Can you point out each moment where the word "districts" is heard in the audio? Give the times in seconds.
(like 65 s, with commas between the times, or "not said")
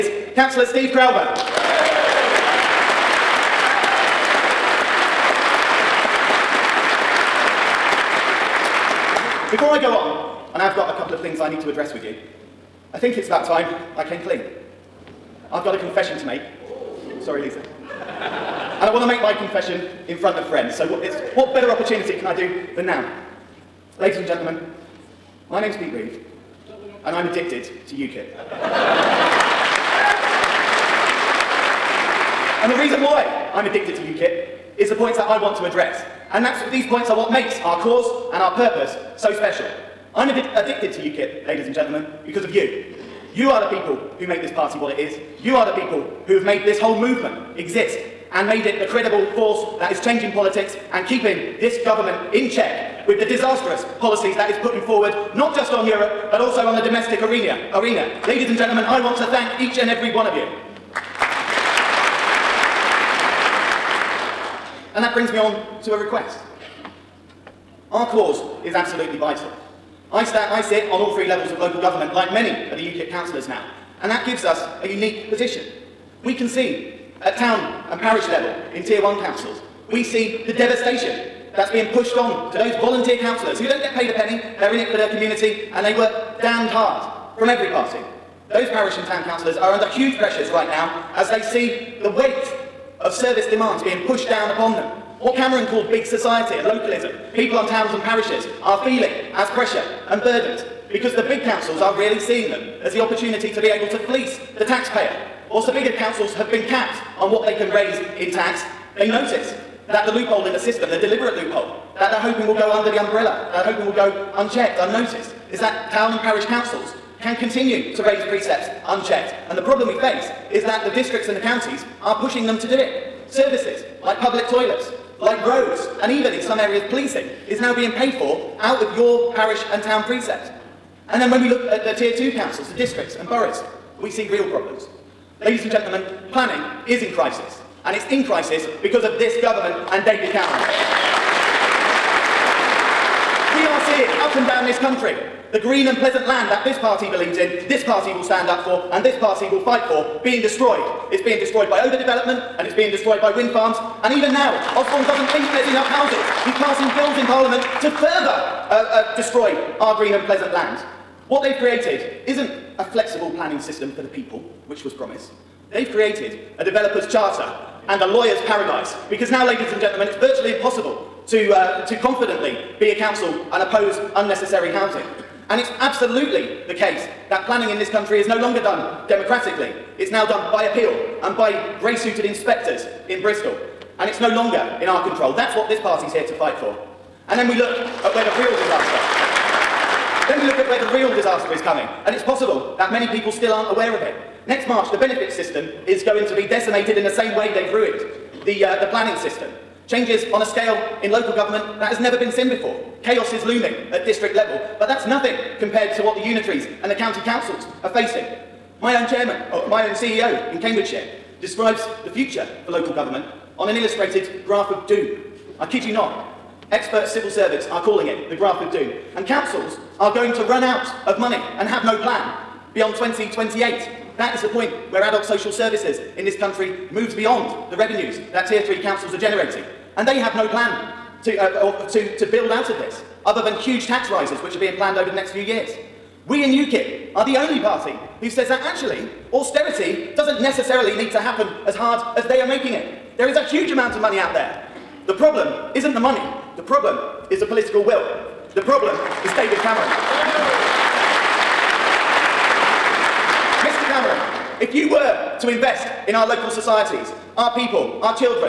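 120 s, 132 s, 204 s.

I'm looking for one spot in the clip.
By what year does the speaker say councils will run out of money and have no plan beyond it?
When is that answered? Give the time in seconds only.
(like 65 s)
222 s.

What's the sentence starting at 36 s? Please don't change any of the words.
And that's, these points are what makes our cause and our purpose so special.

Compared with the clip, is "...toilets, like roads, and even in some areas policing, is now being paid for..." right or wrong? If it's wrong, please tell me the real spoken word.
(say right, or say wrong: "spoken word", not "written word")
right.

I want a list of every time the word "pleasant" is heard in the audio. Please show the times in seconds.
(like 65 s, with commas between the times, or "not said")
146 s, 160 s.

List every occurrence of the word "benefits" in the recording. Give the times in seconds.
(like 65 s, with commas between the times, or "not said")
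194 s.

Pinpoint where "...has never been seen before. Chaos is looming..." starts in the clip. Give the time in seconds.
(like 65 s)
201 s.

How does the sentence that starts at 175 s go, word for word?
And it's absolutely the case that planning in this country is no longer done democratically.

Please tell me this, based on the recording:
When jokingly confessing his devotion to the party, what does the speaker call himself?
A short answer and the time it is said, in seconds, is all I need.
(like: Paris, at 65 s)
Pete Reeve, at 25 s.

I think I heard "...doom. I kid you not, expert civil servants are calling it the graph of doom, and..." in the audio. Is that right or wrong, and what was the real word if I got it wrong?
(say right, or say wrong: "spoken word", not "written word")
right.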